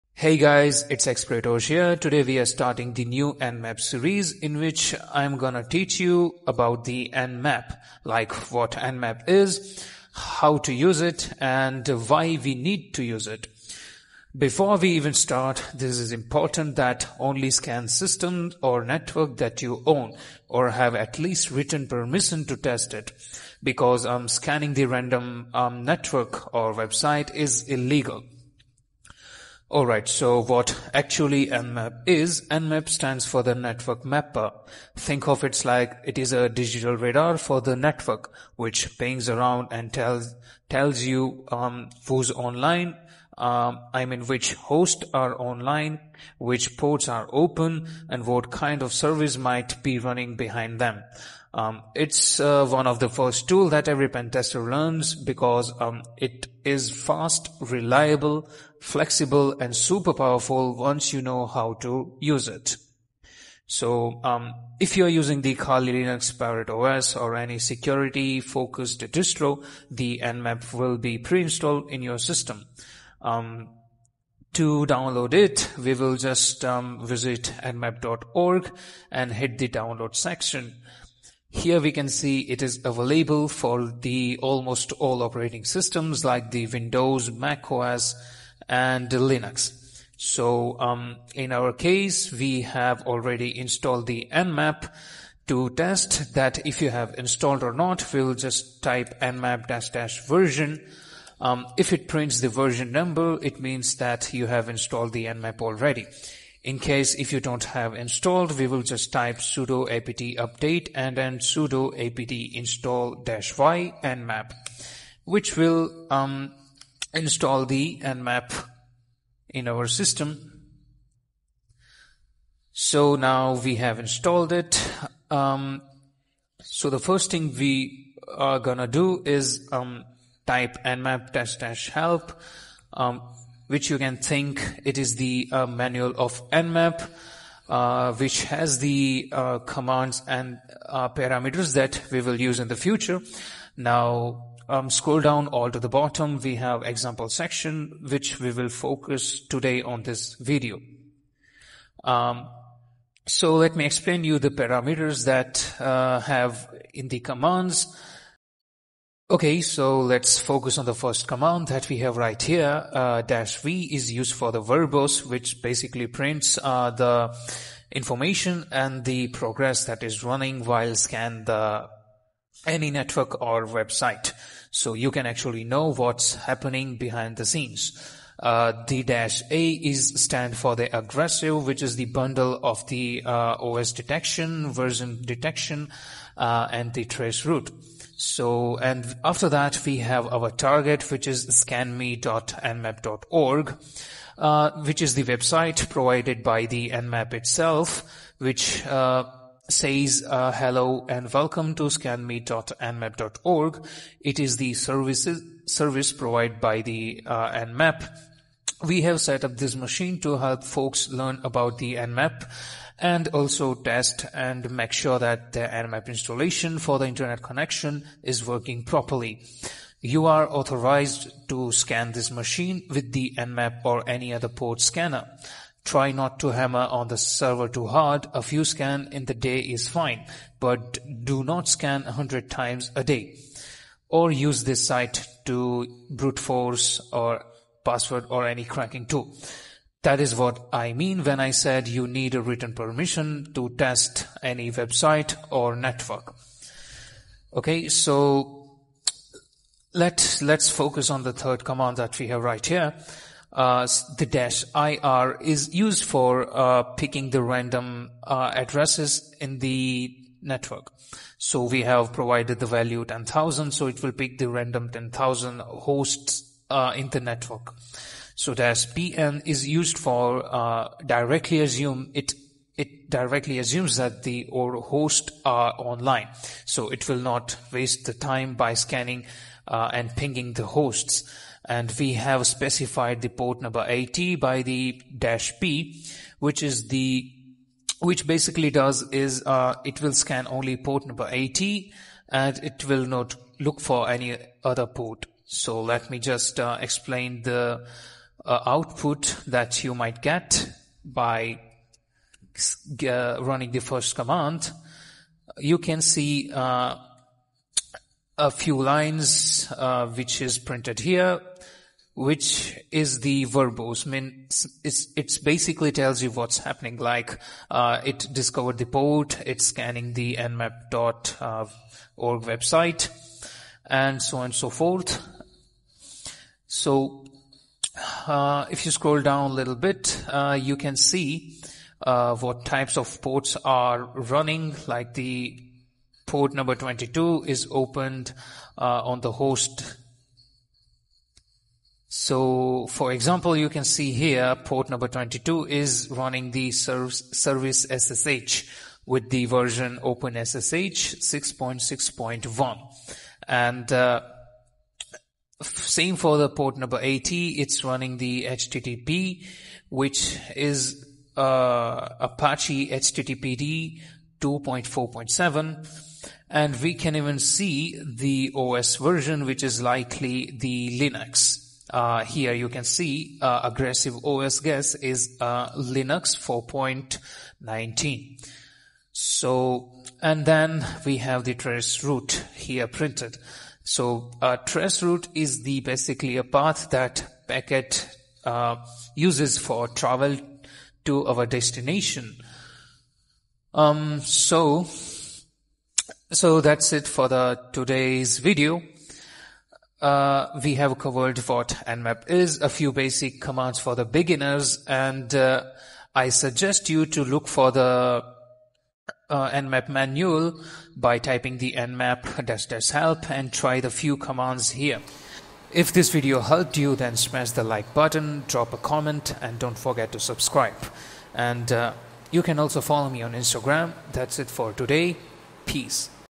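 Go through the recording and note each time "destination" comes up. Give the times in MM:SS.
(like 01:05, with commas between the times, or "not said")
06:31.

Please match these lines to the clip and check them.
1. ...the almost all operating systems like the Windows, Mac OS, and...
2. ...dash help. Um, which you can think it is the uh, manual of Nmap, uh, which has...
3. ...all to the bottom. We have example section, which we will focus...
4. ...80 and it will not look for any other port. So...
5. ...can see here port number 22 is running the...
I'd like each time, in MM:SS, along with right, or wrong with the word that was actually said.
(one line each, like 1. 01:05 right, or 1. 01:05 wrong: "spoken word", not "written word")
1. 01:23 right
2. 02:11 right
3. 02:25 right
4. 04:51 right
5. 05:43 right.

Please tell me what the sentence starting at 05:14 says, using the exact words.
I mean, it's, it's basically tells you what's happening.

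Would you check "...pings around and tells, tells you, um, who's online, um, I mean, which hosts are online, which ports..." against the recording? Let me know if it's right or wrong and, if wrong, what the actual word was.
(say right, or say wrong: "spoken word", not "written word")
right.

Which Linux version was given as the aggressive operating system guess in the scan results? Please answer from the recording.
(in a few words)
Linux 4.19.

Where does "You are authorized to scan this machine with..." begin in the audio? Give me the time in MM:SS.
03:40.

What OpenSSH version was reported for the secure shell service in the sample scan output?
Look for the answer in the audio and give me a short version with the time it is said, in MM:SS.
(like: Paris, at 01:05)
6.6.1, at 05:50.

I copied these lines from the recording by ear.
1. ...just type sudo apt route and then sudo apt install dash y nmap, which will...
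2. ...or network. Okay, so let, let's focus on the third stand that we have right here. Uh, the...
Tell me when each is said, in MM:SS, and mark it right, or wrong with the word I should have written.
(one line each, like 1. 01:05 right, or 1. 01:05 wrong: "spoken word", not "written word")
1. 01:48 wrong: "update", not "route"
2. 04:05 wrong: "command", not "stand".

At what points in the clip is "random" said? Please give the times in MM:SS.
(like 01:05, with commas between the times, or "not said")
00:24, 04:17, 04:24.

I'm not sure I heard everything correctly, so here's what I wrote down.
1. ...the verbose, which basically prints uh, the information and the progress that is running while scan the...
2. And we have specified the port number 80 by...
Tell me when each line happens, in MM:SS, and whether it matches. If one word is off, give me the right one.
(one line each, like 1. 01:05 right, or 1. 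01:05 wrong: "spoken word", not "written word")
1. 02:44 right
2. 04:41 right.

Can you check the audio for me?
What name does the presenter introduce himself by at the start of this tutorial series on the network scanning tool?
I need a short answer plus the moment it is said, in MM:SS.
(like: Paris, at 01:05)
Exploitosh, at 00:01.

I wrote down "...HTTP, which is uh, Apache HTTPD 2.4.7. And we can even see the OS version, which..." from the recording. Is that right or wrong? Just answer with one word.
right.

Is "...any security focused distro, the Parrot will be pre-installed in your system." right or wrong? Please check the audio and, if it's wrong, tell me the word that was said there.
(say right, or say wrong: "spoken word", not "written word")
wrong: "Nmap", not "Parrot".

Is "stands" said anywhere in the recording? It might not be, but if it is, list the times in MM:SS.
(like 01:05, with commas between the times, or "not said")
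00:32, 03:00.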